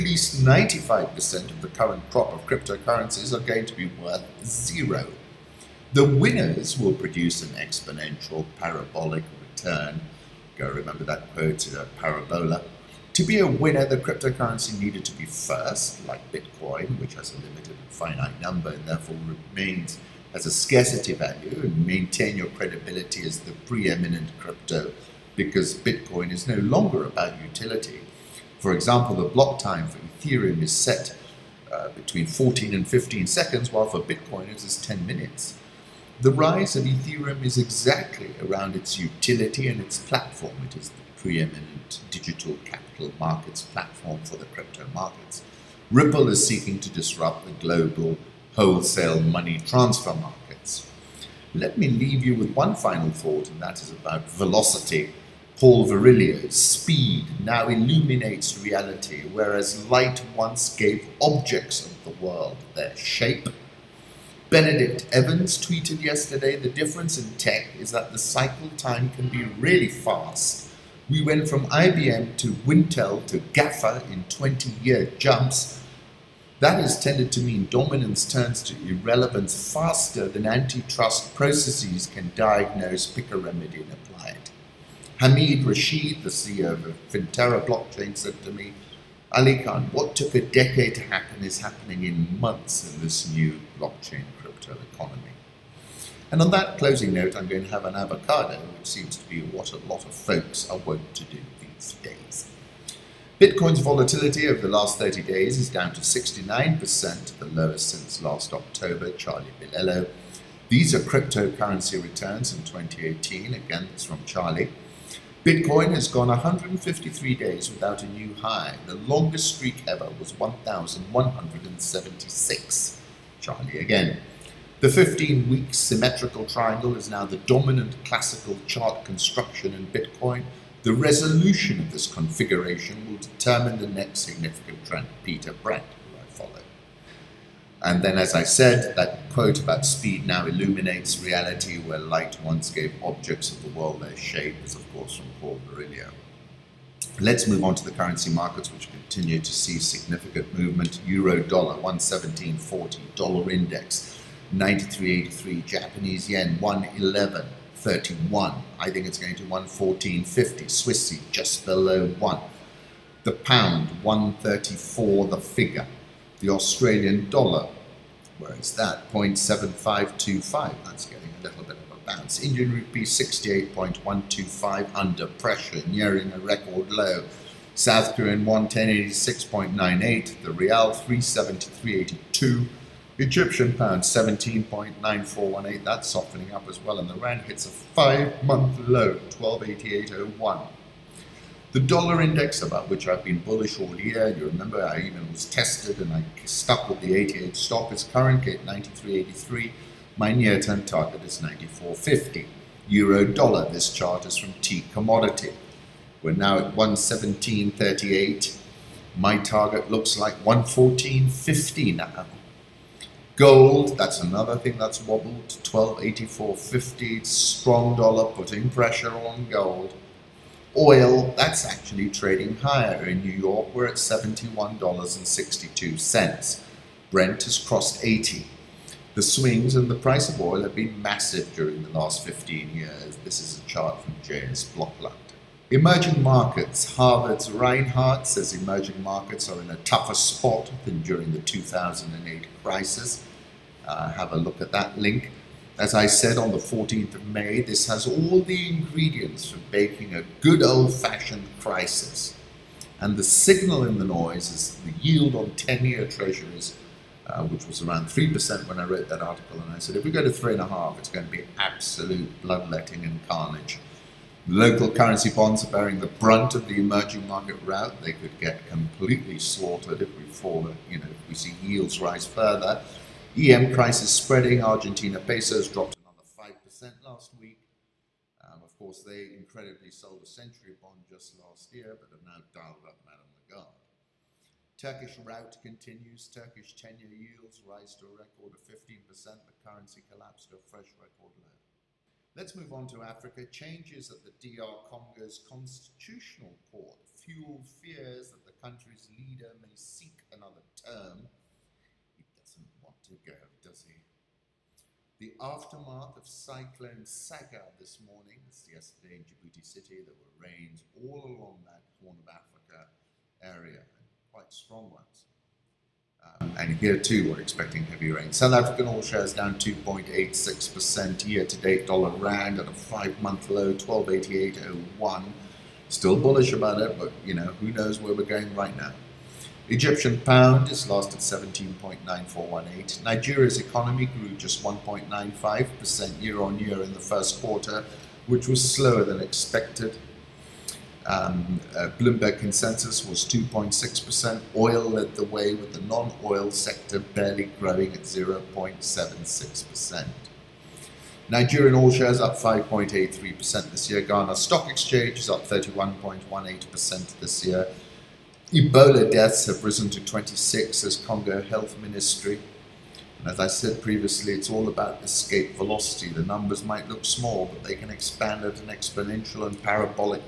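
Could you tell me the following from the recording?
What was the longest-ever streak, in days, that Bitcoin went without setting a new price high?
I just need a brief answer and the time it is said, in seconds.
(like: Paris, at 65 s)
1,176, at 120 s.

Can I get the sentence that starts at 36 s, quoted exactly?
The rise of Ethereum is exactly around its utility and its platform.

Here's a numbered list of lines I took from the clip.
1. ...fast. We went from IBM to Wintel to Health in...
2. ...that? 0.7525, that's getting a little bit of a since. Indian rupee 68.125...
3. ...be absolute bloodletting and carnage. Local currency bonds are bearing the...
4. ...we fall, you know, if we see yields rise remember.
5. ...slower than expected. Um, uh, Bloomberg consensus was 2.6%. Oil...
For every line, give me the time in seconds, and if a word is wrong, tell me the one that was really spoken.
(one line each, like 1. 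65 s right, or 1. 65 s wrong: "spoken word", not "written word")
1. 69 s wrong: "GAFA", not "Health"
2. 168 s wrong: "bounce", not "since"
3. 261 s right
4. 270 s wrong: "further", not "remember"
5. 338 s right.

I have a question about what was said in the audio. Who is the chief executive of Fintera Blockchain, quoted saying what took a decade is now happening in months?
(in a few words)
Hamid Rashid.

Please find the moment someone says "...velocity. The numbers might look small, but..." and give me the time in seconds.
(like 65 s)
365 s.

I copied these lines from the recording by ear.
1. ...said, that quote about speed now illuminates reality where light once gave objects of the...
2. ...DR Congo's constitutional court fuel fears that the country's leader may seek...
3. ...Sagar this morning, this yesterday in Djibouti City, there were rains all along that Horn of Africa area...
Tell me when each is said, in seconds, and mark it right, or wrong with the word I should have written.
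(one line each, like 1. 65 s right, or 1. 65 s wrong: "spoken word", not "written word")
1. 138 s right
2. 294 s right
3. 307 s right.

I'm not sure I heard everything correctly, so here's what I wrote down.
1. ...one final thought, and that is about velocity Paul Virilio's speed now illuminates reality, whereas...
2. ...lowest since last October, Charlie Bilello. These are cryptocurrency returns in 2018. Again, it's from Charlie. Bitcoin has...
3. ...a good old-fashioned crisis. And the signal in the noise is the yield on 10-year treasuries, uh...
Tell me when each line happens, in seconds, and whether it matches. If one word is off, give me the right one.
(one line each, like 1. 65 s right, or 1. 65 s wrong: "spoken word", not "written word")
1. 52 s right
2. 107 s right
3. 250 s right.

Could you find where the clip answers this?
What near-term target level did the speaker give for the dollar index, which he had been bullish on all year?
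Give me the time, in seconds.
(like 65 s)
201 s.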